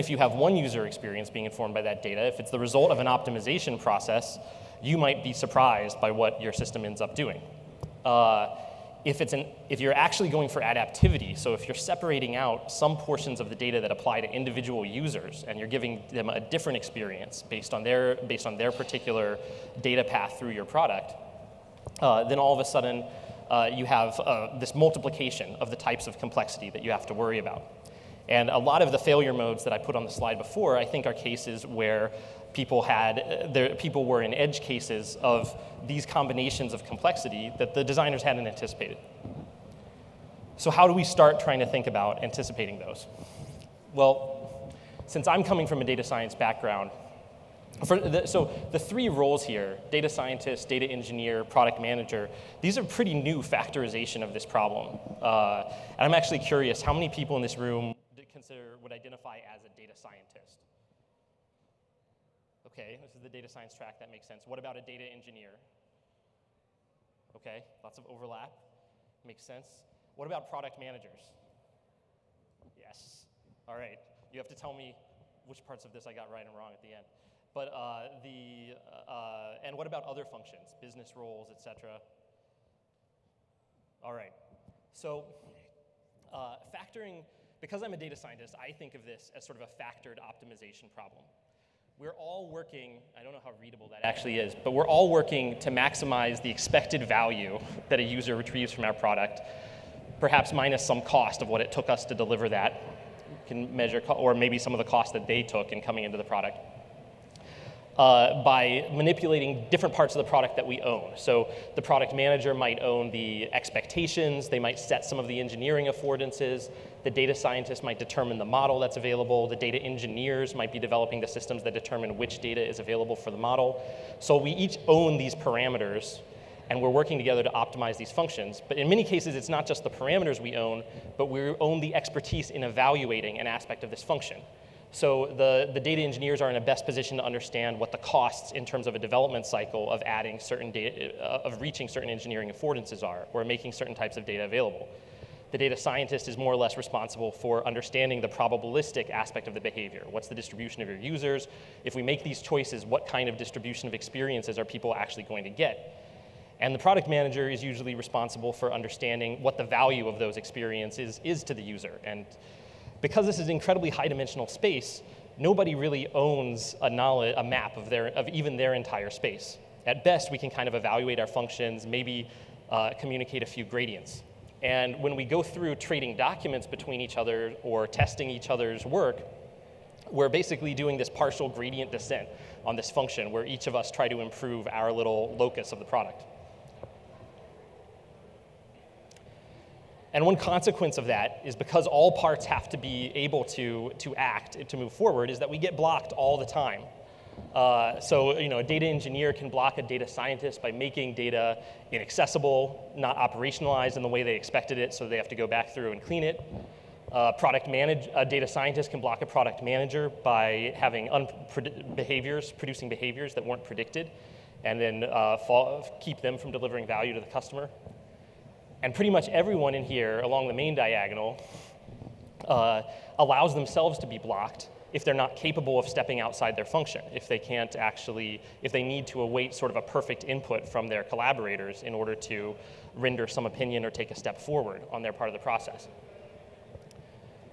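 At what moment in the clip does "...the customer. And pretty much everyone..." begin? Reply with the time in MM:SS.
03:37.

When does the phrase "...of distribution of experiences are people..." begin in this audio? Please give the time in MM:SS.
02:33.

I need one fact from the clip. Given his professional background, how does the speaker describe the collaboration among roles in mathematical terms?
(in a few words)
Factored optimization problem.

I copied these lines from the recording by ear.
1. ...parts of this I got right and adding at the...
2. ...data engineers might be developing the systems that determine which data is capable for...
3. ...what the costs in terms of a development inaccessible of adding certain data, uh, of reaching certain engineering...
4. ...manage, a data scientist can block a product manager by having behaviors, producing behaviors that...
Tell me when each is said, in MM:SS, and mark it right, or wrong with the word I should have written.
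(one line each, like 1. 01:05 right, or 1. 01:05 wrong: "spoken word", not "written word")
1. 01:15 wrong: "wrong", not "adding"
2. 01:59 wrong: "available", not "capable"
3. 02:17 wrong: "cycle", not "inaccessible"
4. 03:27 right.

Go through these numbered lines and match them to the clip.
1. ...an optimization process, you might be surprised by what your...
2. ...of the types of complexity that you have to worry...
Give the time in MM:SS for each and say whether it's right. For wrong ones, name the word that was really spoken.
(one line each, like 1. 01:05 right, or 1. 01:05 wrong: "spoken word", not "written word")
1. 00:02 right
2. 00:25 right.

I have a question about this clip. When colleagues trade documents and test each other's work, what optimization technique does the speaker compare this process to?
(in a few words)
Partial gradient descent.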